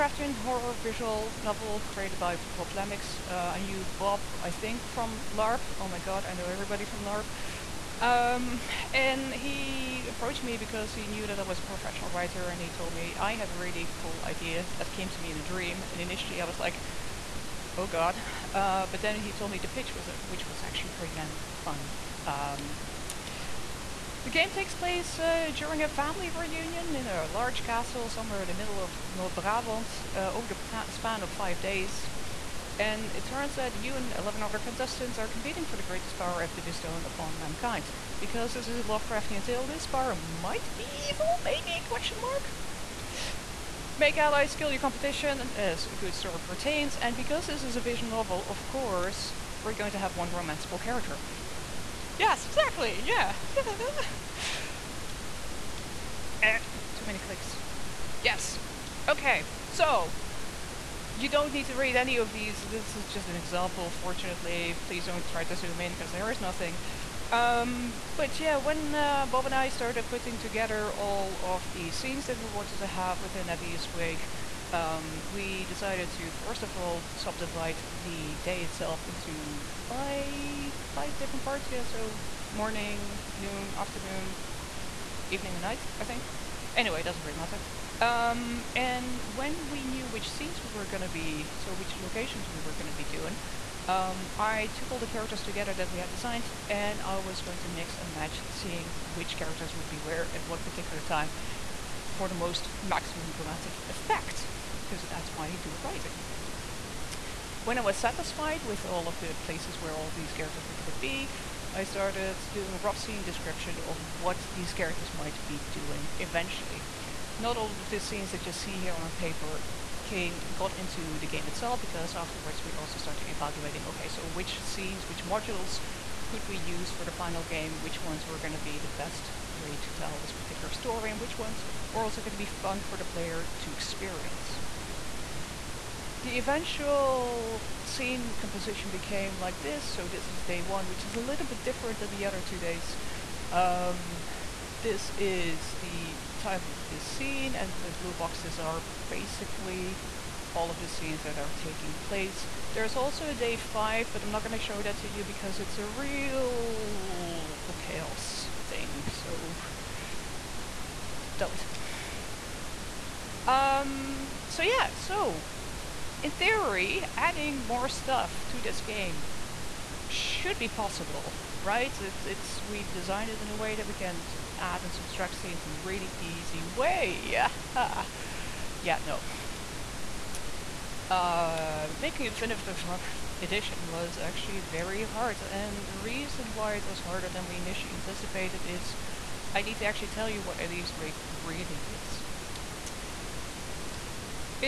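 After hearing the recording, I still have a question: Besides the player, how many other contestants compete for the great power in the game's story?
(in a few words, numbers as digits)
11.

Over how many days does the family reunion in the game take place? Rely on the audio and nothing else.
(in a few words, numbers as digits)
5.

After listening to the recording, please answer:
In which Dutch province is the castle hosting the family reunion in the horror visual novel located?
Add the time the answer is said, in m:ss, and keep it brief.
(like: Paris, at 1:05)
North Brabant, at 0:29.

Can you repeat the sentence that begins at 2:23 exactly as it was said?
Um, this is the time of this scene, and the blue boxes are basically all of the scenes that are taking place.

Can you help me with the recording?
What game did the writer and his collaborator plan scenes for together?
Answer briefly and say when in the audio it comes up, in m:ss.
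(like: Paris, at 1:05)
At Eve's Wake, at 1:13.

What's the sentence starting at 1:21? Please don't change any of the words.
Yeah, so morning, noon, afternoon, evening and night, I think.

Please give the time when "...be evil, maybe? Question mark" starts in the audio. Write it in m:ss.
0:40.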